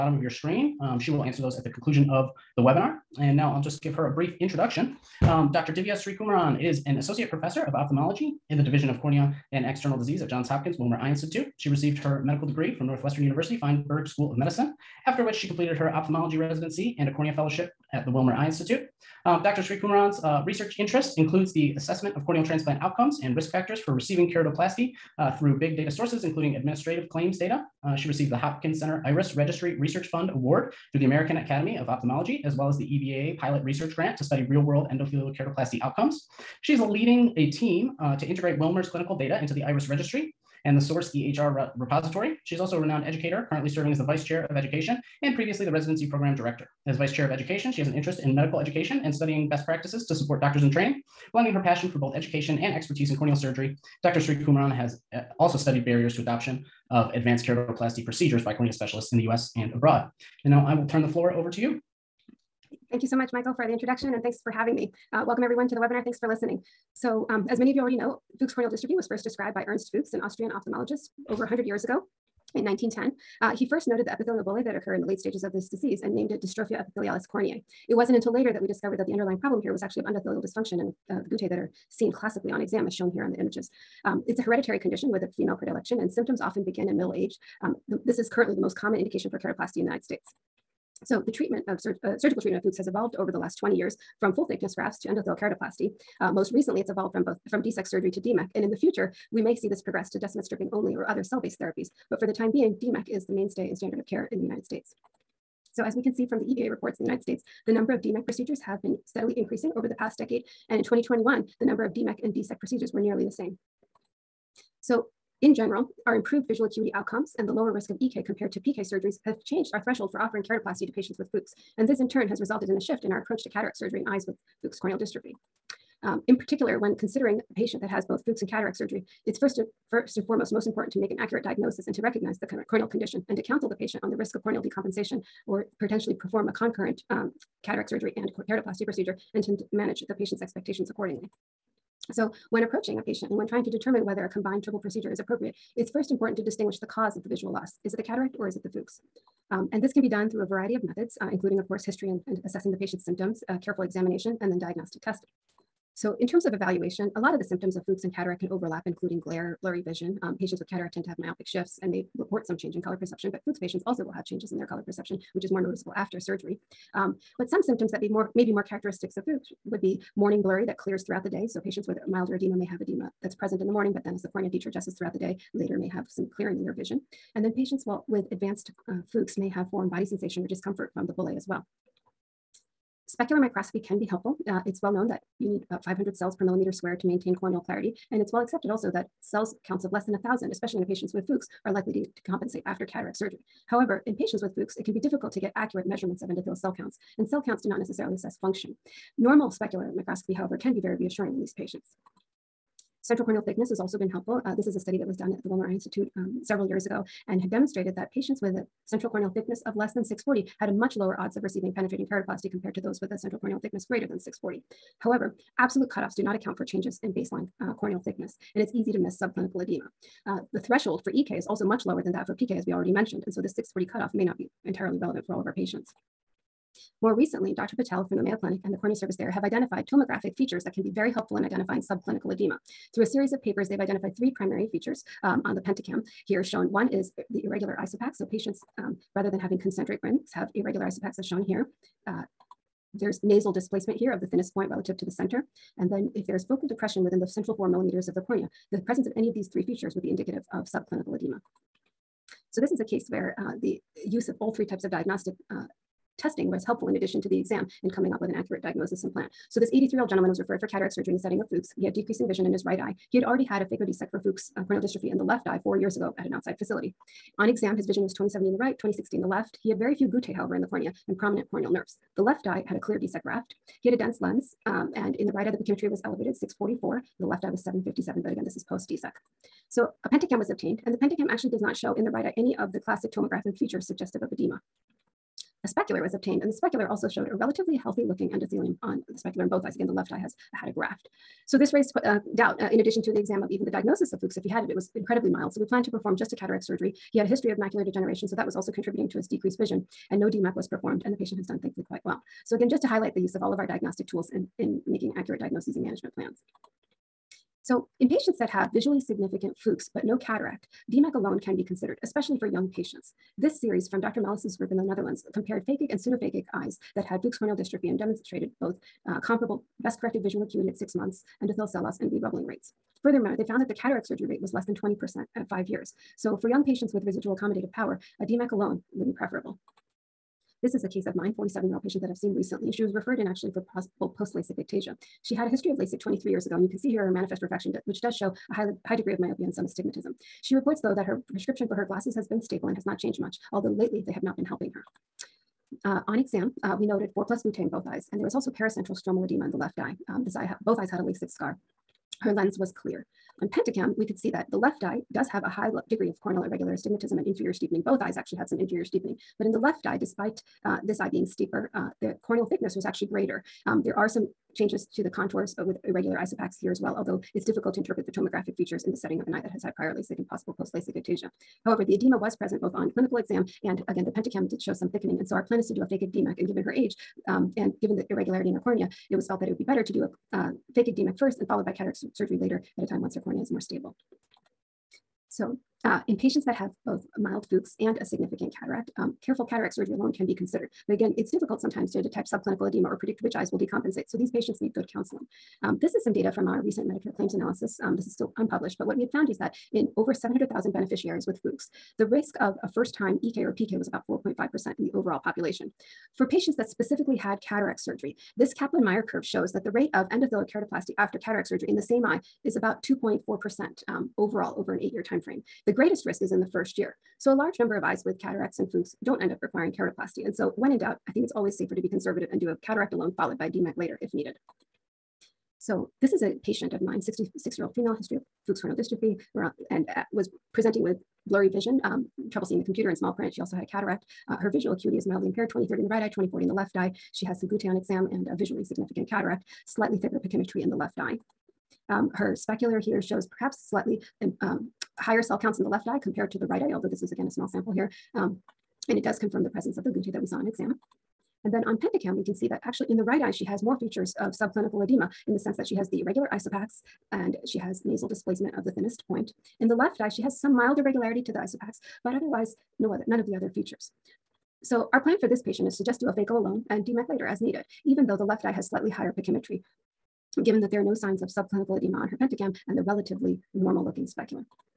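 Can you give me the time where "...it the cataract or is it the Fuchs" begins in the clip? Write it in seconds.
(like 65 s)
147 s.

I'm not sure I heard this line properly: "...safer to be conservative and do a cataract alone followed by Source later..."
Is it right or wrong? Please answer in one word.
wrong.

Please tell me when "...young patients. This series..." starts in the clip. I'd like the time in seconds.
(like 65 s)
312 s.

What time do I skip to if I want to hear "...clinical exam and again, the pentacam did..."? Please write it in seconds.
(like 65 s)
372 s.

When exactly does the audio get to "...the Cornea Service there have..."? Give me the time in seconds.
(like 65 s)
228 s.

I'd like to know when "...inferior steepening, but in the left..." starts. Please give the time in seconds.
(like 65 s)
358 s.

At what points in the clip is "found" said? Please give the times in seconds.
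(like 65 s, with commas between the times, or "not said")
323 s, 399 s.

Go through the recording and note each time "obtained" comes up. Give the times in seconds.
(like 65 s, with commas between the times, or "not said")
280 s, 286 s.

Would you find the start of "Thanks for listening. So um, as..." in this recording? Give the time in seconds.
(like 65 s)
66 s.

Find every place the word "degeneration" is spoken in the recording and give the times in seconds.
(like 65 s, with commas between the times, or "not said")
297 s.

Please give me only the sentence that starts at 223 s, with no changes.
And so the 640 cutoff may not be entirely relevant for all of our patients.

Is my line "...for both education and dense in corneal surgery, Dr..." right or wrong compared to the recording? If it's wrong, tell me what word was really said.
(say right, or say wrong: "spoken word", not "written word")
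wrong: "expertise", not "dense".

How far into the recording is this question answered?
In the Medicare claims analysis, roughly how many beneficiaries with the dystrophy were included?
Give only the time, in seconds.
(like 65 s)
399 s.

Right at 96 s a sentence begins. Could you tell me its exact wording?
Uh, most recently, it's evolved from both from DSAEK surgery to DMEK.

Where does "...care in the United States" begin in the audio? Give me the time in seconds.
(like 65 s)
104 s.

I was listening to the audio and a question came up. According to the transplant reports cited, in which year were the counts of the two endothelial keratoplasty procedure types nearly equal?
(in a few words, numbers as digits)
2021.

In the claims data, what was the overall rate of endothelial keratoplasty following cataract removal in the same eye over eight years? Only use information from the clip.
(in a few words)
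2.4%.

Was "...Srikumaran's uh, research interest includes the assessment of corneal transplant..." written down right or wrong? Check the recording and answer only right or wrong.
right.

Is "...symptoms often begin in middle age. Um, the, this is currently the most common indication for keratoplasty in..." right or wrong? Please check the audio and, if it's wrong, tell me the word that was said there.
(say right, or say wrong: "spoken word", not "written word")
right.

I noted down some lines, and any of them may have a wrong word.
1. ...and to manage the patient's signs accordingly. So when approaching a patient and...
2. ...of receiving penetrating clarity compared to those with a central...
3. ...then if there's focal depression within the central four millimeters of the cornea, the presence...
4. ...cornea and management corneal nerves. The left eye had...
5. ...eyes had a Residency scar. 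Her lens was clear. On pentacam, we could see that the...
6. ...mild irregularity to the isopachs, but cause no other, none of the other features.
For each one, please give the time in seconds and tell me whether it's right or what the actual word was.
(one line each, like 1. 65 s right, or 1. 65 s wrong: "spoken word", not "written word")
1. 139 s wrong: "expectations", not "signs"
2. 211 s wrong: "keratoplasty", not "clarity"
3. 245 s right
4. 270 s wrong: "prominent", not "management"
5. 350 s wrong: "LASIK", not "Residency"
6. 460 s wrong: "otherwise", not "cause".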